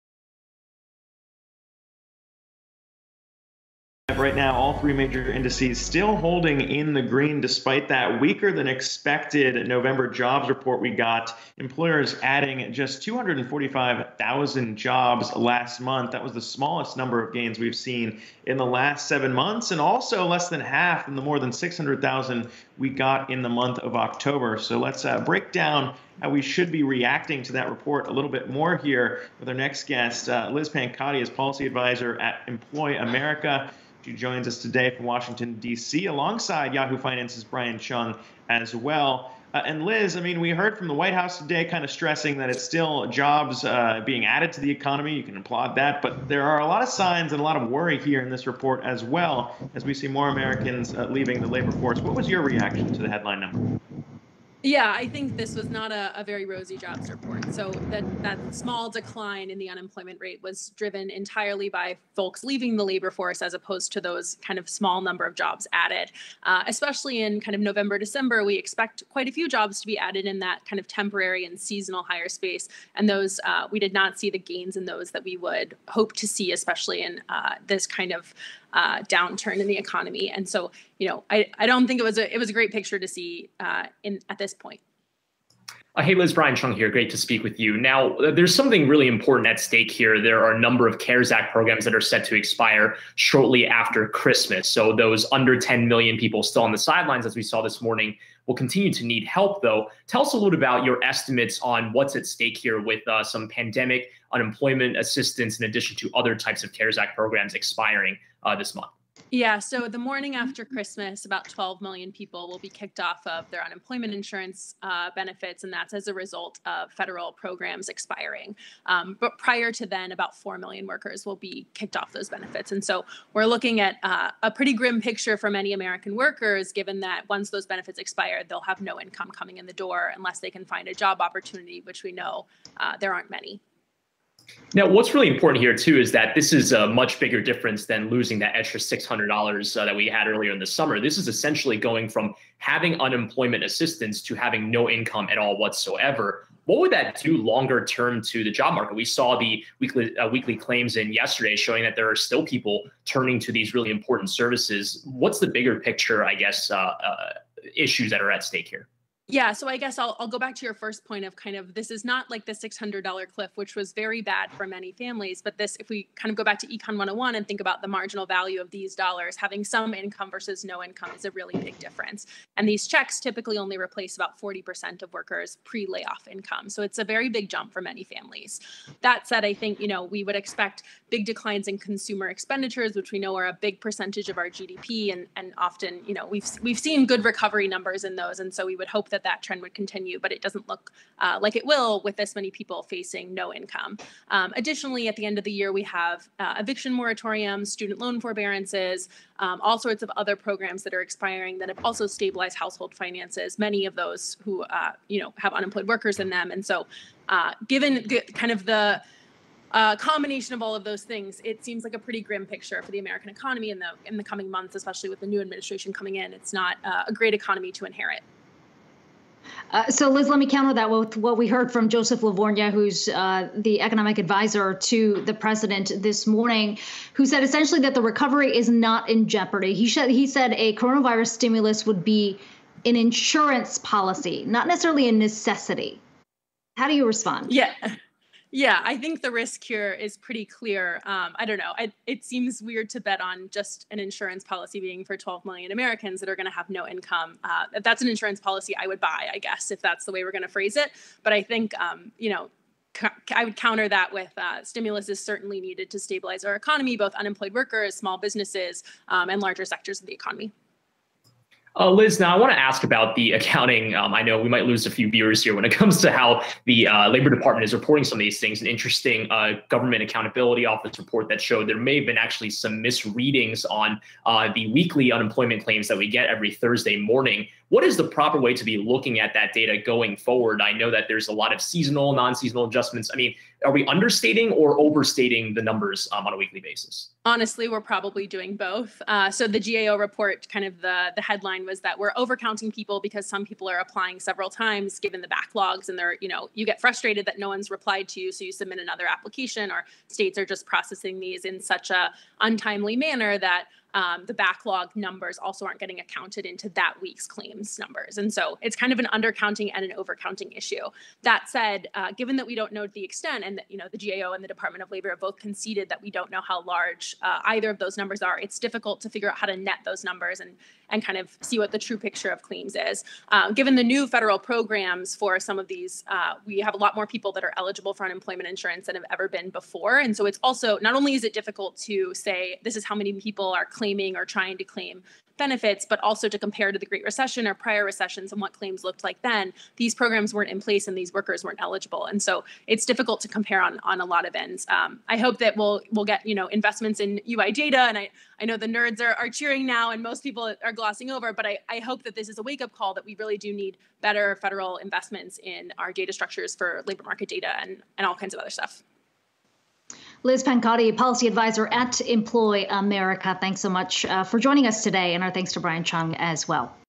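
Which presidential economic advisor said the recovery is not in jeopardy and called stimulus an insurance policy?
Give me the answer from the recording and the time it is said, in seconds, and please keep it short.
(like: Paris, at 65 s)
Joseph LaVorgna, at 221 s.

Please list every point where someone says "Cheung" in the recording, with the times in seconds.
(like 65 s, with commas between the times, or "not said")
37 s, 86 s, 365 s.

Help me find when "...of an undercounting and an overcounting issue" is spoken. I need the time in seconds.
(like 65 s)
308 s.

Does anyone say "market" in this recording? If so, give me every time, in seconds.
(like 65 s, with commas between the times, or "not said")
148 s, 357 s.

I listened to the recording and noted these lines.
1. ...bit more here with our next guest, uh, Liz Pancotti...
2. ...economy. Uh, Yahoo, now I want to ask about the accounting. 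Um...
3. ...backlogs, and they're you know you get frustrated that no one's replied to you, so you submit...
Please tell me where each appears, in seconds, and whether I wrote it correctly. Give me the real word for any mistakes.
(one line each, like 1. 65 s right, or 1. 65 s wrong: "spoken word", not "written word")
1. 28 s right
2. 260 s wrong: "Liz", not "Yahoo"
3. 295 s right.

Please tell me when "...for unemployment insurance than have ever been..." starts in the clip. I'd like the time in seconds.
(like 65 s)
327 s.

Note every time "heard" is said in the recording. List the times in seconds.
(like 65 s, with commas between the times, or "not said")
40 s, 221 s.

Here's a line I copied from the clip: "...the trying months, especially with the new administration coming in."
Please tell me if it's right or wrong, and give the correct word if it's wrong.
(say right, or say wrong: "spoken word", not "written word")
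wrong: "coming", not "trying".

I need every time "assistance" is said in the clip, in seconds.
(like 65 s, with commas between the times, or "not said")
104 s, 143 s.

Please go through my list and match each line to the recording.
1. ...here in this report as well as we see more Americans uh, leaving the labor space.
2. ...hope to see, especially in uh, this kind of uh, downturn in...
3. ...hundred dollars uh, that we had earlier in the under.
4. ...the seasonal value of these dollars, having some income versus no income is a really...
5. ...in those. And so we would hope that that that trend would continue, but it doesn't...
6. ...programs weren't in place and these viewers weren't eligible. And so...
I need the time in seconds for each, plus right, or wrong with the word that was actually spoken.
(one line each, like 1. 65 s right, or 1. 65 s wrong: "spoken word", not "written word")
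1. 48 s wrong: "force", not "space"
2. 75 s right
3. 139 s wrong: "summer", not "under"
4. 167 s wrong: "marginal", not "seasonal"
5. 188 s right
6. 339 s wrong: "workers", not "viewers".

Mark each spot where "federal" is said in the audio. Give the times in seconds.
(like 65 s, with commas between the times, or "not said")
116 s, 324 s, 354 s.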